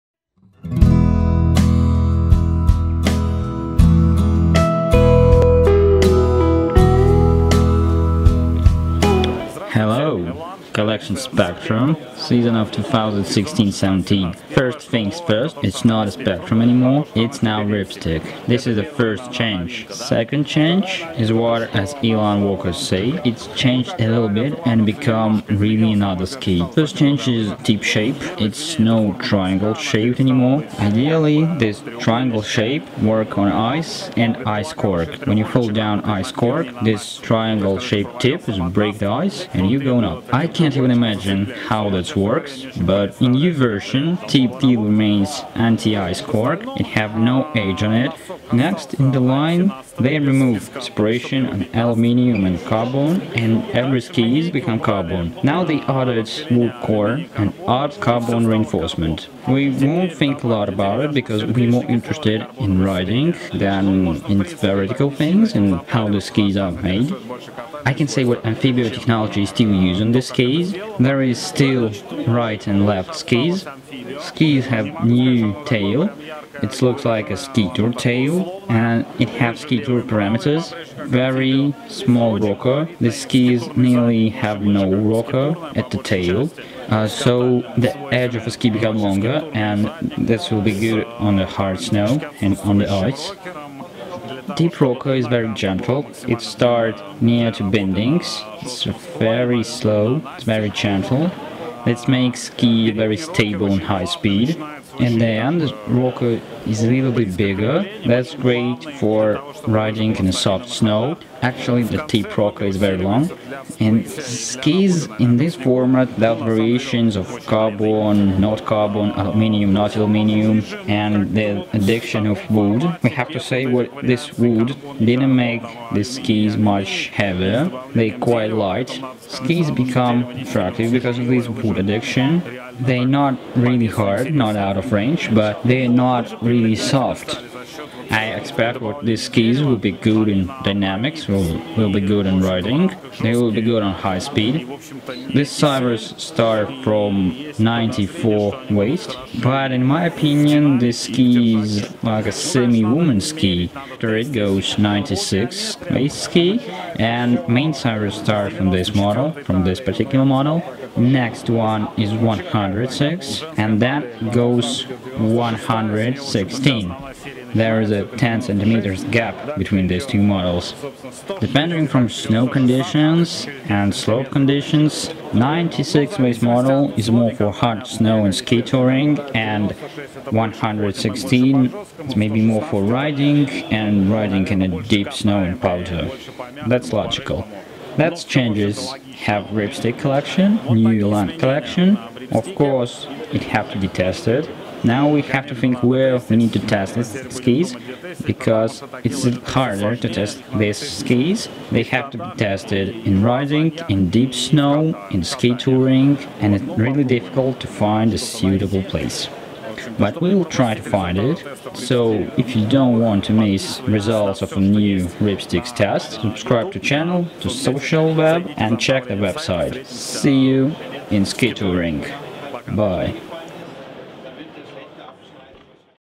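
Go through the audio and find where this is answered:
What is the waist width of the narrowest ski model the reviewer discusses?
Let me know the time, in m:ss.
2:27.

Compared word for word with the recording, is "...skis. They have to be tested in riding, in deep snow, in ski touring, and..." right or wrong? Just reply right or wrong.
right.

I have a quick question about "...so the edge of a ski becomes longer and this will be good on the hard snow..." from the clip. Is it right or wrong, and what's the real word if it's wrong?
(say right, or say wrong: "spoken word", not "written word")
right.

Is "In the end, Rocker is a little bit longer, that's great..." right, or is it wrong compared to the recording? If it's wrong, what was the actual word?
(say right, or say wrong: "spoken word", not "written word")
wrong: "bigger", not "longer".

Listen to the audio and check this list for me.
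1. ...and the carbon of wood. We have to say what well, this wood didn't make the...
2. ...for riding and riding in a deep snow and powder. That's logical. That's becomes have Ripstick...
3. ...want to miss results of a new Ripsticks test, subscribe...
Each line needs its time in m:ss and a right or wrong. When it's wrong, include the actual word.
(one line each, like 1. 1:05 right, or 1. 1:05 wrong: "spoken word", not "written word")
1. 2:00 wrong: "addiction", not "carbon"
2. 3:02 wrong: "changes", not "becomes"
3. 3:32 right.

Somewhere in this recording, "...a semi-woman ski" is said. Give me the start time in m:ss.
2:32.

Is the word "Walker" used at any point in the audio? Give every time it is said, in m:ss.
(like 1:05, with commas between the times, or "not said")
0:22.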